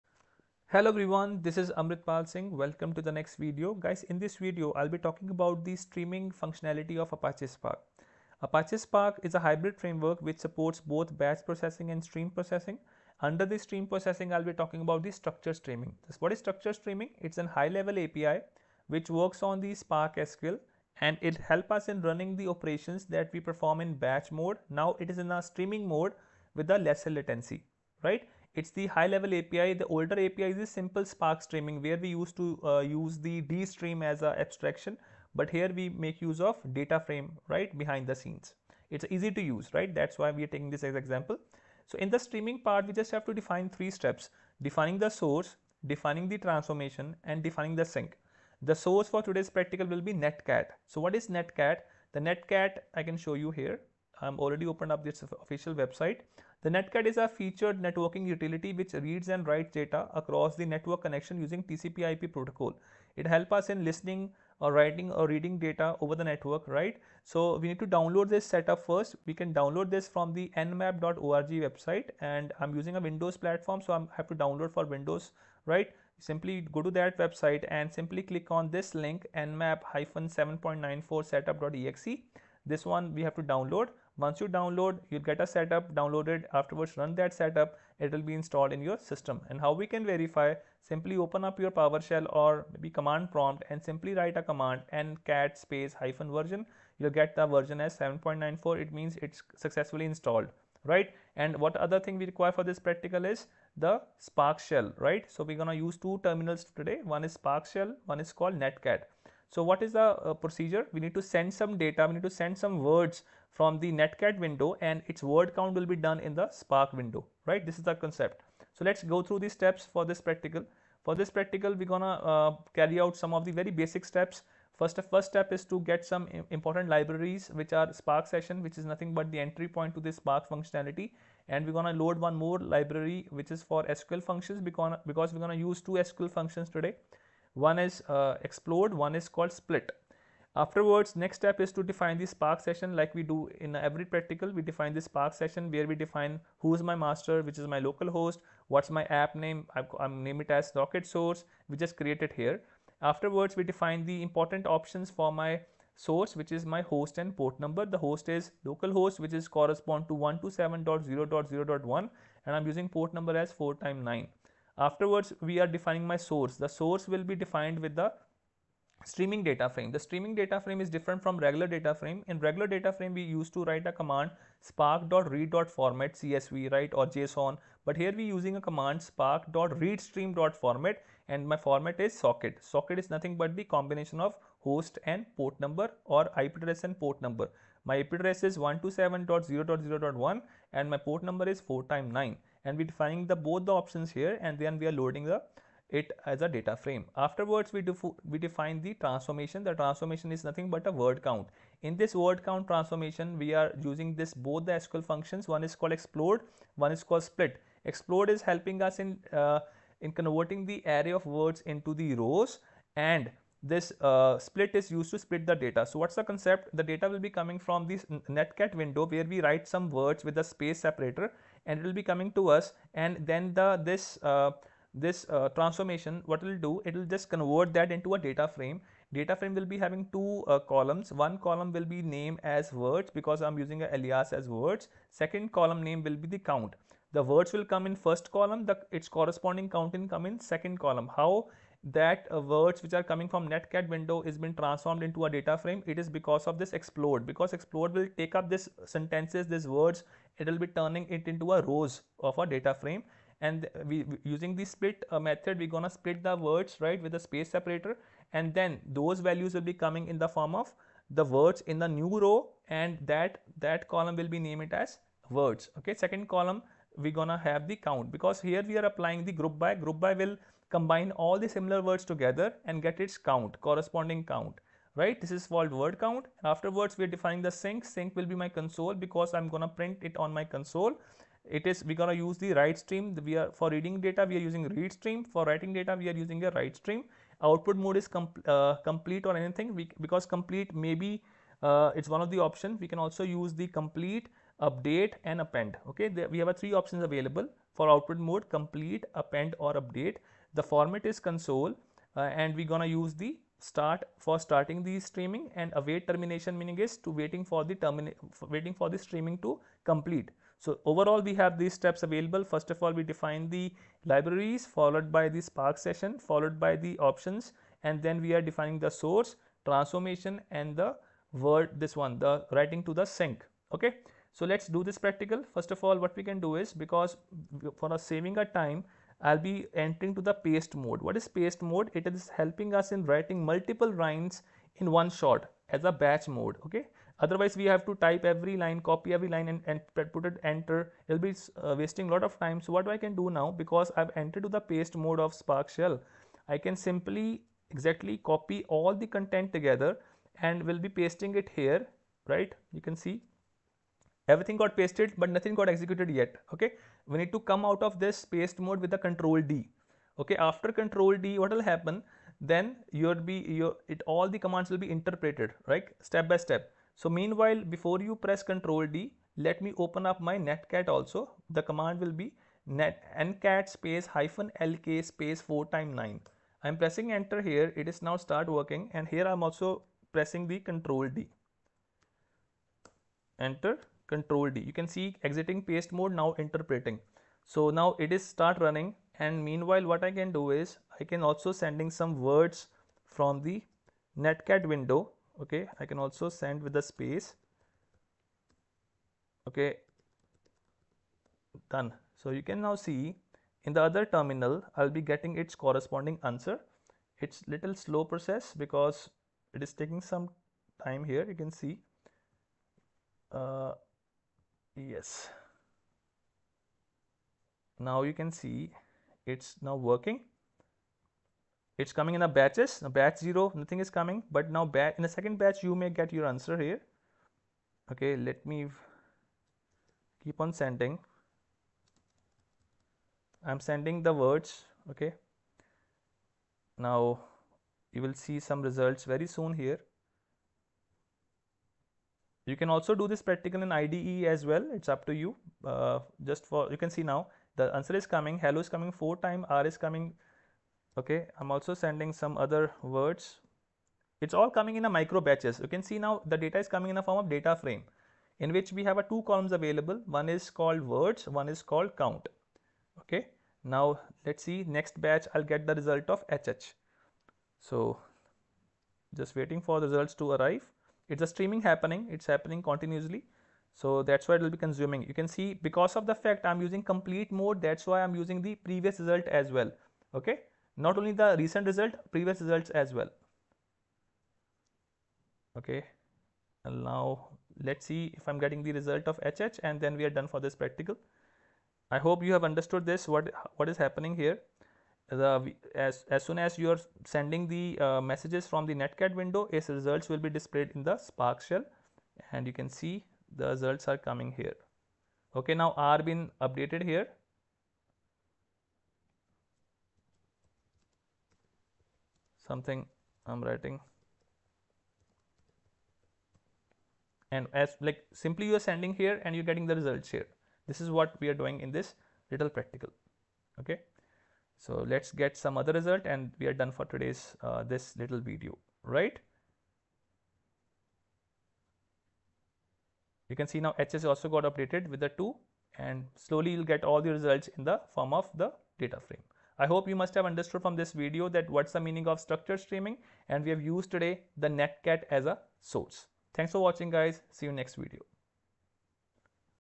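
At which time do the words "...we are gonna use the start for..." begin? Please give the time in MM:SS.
05:02.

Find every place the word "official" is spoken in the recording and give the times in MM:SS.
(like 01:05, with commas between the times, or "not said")
00:55.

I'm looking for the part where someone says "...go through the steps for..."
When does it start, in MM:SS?
01:59.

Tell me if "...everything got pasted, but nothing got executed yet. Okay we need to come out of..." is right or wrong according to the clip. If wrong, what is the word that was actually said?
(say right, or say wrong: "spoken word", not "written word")
right.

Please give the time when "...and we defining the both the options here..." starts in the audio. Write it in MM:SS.
03:12.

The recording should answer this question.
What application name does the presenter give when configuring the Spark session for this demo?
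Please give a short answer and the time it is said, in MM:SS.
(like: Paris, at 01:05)
Socket Source, at 02:30.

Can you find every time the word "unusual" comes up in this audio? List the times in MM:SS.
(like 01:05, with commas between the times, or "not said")
not said.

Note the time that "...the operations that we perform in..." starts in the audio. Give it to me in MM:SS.
00:22.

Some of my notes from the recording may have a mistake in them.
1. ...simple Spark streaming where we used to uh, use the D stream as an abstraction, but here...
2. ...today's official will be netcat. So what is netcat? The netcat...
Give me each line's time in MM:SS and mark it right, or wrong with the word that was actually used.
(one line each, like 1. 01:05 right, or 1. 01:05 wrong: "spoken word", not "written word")
1. 00:30 right
2. 00:49 wrong: "practical", not "official".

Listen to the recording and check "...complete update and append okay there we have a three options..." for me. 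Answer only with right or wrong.
right.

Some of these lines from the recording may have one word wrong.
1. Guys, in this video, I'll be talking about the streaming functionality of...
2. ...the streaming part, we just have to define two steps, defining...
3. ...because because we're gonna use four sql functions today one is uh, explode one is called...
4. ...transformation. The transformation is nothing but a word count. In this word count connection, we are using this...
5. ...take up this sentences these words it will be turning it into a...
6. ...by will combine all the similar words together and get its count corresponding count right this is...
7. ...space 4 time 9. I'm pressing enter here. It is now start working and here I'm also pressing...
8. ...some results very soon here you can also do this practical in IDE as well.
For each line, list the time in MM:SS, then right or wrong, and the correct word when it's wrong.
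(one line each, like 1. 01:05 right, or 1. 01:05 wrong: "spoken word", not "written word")
1. 00:03 right
2. 00:42 wrong: "three", not "two"
3. 02:14 wrong: "two", not "four"
4. 03:18 wrong: "transformation", not "connection"
5. 04:08 right
6. 04:29 right
7. 06:15 right
8. 07:18 right.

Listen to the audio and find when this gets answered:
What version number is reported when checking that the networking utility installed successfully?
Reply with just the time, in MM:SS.
01:37.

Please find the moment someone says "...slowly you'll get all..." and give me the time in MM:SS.
08:56.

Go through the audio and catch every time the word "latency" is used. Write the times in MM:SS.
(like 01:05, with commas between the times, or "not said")
00:27.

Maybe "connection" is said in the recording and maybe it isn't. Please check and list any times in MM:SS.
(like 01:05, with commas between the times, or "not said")
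01:01.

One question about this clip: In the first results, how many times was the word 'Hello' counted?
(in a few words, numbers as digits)
4.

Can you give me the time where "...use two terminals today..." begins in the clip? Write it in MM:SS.
01:45.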